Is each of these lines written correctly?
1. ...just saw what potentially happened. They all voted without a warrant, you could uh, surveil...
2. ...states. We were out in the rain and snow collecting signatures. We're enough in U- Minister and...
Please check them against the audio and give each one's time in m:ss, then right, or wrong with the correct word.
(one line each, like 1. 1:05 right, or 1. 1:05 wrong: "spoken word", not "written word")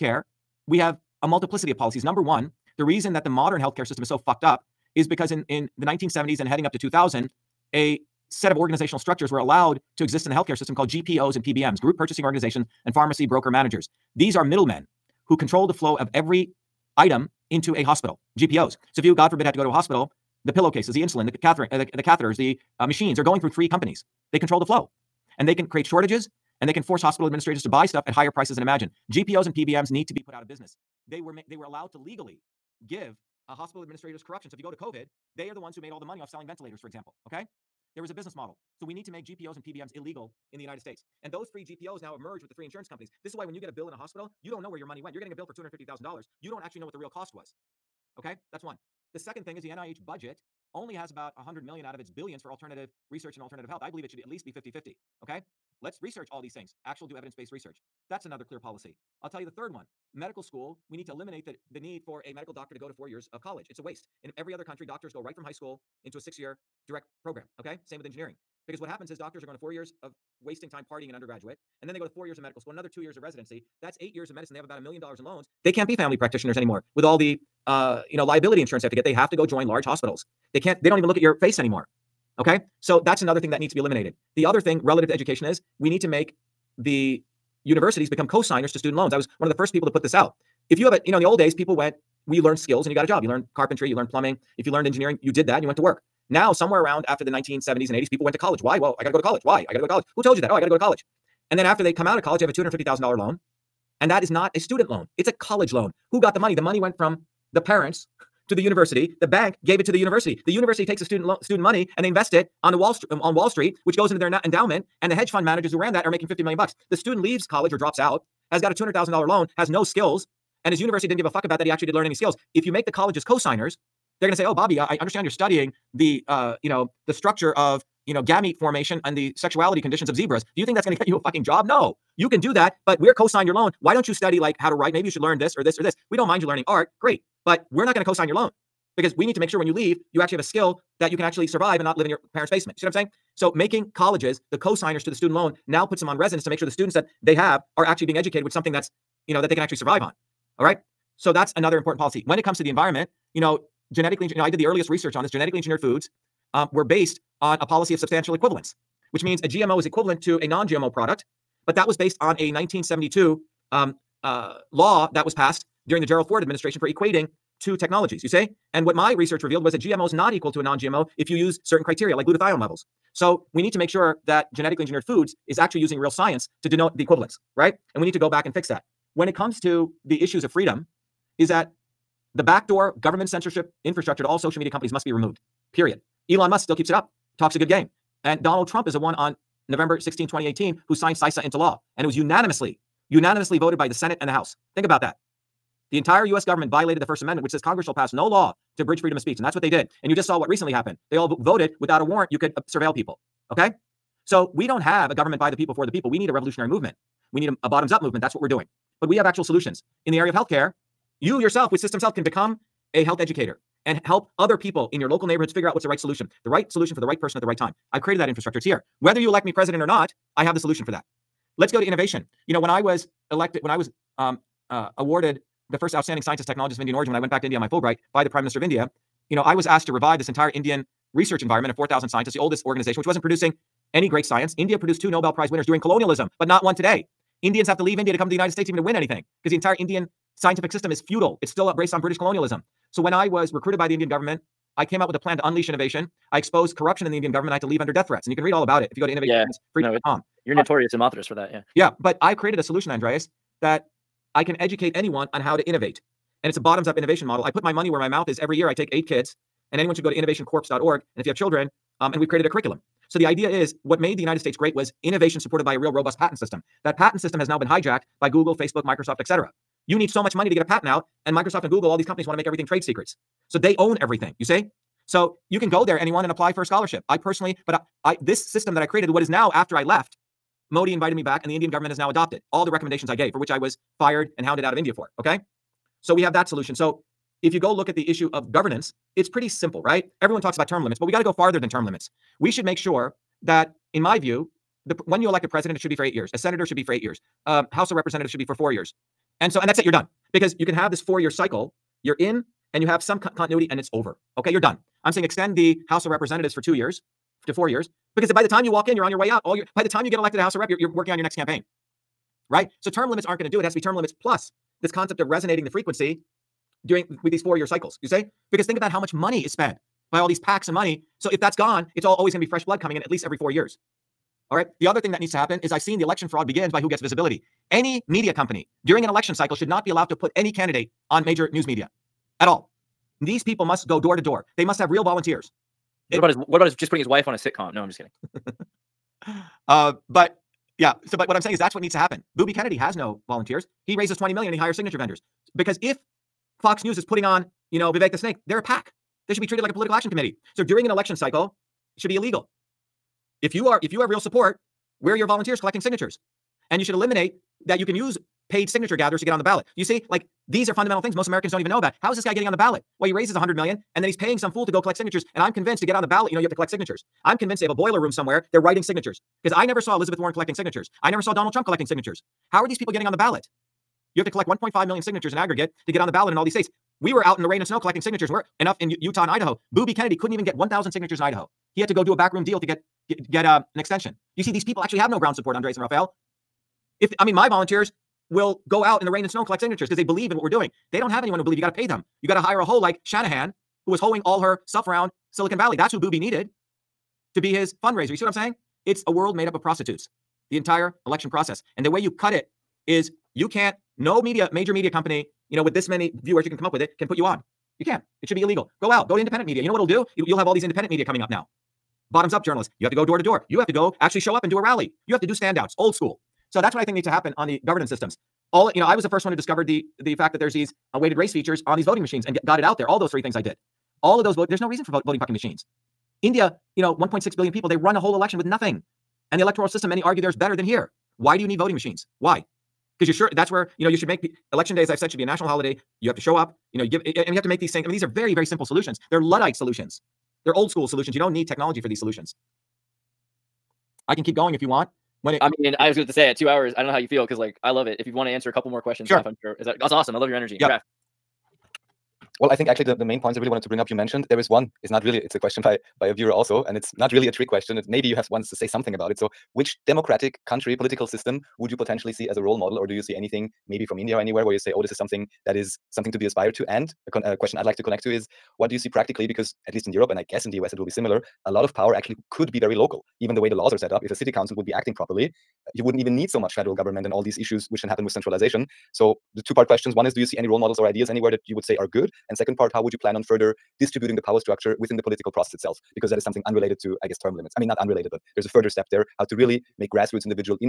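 1. 3:20 wrong: "recently", not "potentially"
2. 6:16 wrong: "Utah", not "Minister".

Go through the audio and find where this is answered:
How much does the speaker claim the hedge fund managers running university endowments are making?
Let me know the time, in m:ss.
1:56.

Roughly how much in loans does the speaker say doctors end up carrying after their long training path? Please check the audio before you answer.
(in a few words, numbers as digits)
a million dollars.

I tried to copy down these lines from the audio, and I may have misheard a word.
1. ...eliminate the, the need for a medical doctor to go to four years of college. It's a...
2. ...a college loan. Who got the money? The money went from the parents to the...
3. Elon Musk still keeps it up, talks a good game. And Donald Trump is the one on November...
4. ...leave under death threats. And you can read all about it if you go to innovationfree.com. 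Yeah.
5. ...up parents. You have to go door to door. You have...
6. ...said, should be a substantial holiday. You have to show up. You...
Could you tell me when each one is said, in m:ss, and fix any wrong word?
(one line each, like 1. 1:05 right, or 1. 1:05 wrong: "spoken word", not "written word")
1. 1:01 right
2. 1:45 right
3. 3:06 right
4. 4:07 right
5. 6:52 wrong: "journalists", not "parents"
6. 7:14 wrong: "national", not "substantial".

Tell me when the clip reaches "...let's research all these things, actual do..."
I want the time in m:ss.
0:55.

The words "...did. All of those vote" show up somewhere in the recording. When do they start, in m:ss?
7:03.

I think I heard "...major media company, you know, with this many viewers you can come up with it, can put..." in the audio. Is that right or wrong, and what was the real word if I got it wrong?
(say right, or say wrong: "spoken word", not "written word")
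right.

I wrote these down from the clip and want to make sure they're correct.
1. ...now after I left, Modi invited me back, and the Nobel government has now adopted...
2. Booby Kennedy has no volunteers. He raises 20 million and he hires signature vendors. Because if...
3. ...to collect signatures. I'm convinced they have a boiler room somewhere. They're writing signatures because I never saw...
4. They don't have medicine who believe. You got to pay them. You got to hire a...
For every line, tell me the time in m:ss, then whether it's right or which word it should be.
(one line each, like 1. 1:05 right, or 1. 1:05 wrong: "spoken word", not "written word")
1. 4:39 wrong: "Indian", not "Nobel"
2. 5:42 right
3. 6:06 right
4. 6:30 wrong: "anyone", not "medicine".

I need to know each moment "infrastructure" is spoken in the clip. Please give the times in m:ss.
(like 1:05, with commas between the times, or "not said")
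3:03, 3:38.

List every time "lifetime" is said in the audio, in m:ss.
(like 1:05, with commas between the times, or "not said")
not said.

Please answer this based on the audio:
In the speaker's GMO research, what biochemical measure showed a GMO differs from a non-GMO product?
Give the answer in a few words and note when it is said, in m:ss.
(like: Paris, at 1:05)
glutathione levels, at 2:52.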